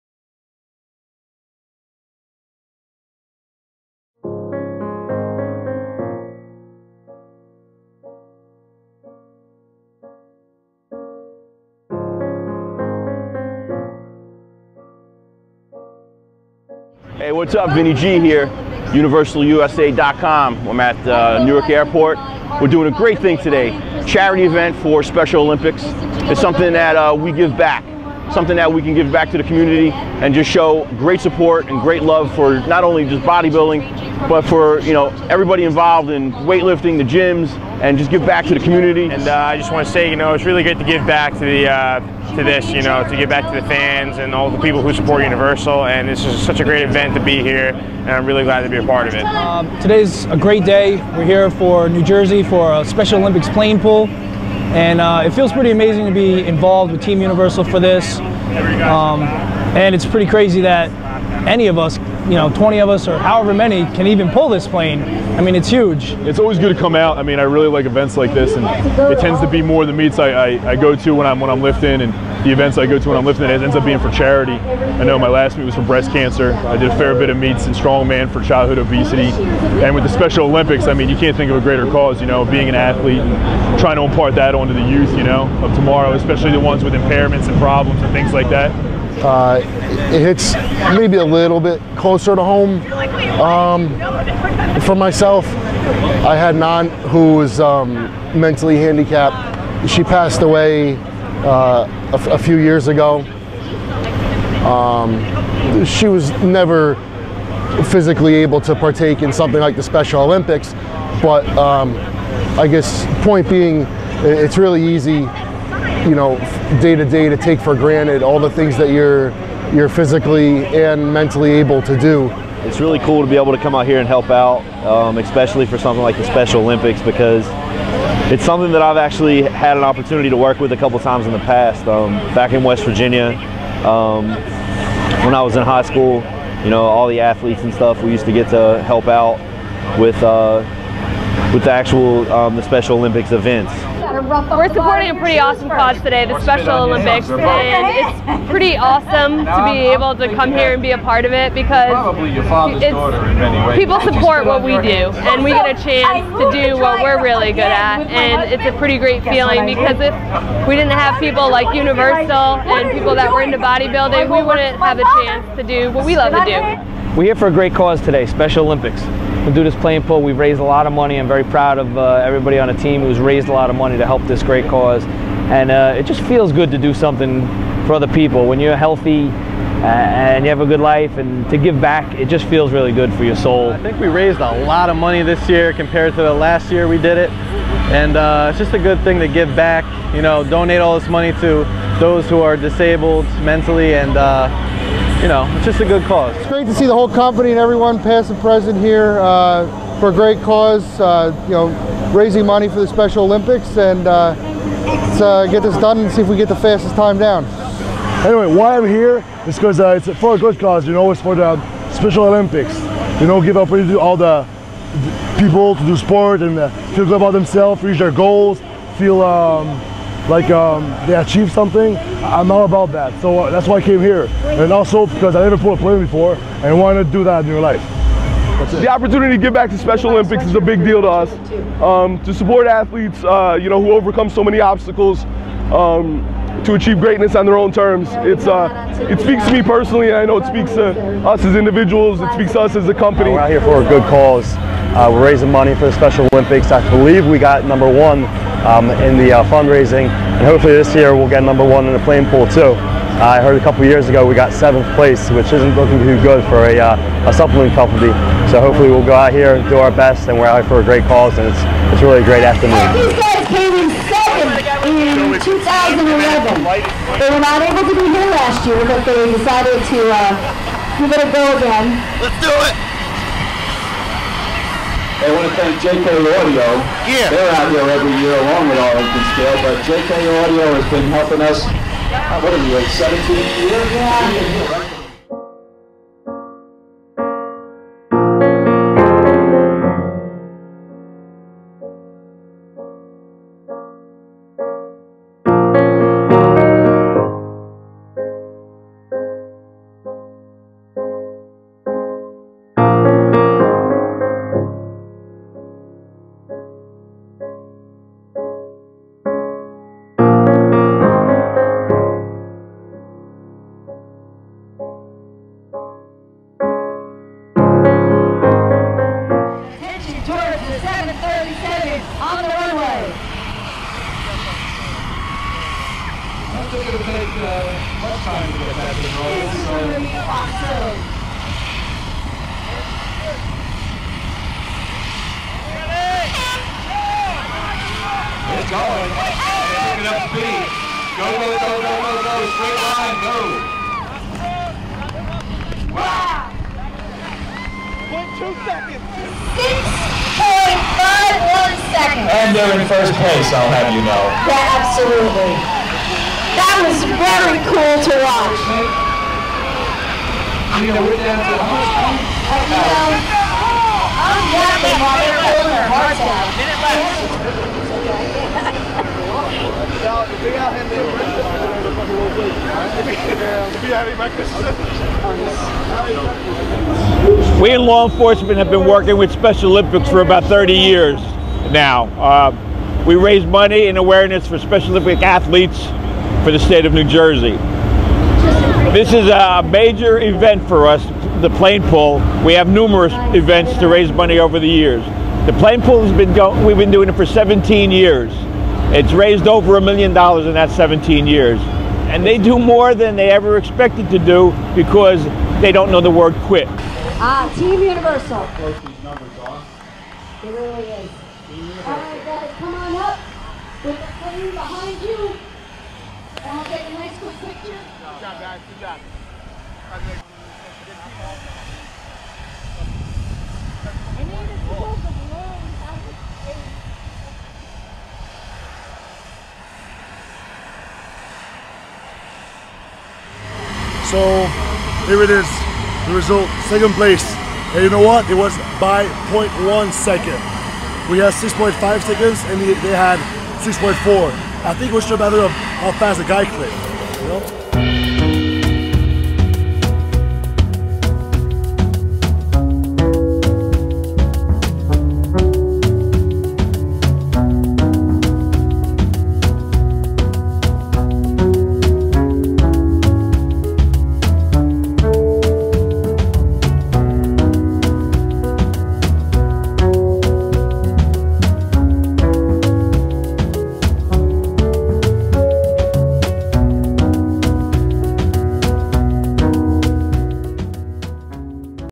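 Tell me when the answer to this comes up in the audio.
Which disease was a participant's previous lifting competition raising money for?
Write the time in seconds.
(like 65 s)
75 s.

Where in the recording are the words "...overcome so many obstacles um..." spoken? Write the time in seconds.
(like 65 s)
233 s.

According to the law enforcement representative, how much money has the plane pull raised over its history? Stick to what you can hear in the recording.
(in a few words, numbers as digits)
over a million dollars.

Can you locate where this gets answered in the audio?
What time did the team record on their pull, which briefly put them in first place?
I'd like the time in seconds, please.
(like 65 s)
349 s.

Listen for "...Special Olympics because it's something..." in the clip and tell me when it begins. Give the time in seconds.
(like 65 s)
126 s.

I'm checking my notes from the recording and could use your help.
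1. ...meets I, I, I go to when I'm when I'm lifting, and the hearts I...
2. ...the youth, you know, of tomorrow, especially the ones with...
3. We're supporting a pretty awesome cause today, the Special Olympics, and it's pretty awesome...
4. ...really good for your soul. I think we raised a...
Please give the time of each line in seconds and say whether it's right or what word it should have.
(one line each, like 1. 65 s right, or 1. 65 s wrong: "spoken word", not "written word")
1. 69 s wrong: "events", not "hearts"
2. 84 s right
3. 144 s right
4. 182 s right.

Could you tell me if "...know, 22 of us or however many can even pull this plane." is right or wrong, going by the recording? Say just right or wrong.
wrong.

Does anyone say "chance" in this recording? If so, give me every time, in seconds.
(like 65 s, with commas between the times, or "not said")
155 s, 165 s.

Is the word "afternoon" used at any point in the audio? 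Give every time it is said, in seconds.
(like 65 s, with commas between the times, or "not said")
262 s.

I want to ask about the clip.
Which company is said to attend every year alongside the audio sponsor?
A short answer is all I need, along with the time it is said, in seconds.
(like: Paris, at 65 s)
Arlington Scale, at 278 s.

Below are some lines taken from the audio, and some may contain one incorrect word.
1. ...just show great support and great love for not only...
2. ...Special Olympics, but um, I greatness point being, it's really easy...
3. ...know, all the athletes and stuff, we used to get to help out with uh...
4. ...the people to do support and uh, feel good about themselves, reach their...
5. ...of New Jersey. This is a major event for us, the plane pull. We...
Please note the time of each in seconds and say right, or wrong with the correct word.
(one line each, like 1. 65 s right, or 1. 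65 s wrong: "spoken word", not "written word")
1. 30 s right
2. 109 s wrong: "guess", not "greatness"
3. 136 s right
4. 214 s wrong: "sport", not "support"
5. 386 s right.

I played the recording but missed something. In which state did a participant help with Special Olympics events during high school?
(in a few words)
West Virginia.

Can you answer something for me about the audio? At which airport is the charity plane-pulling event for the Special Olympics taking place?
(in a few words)
Newark Airport.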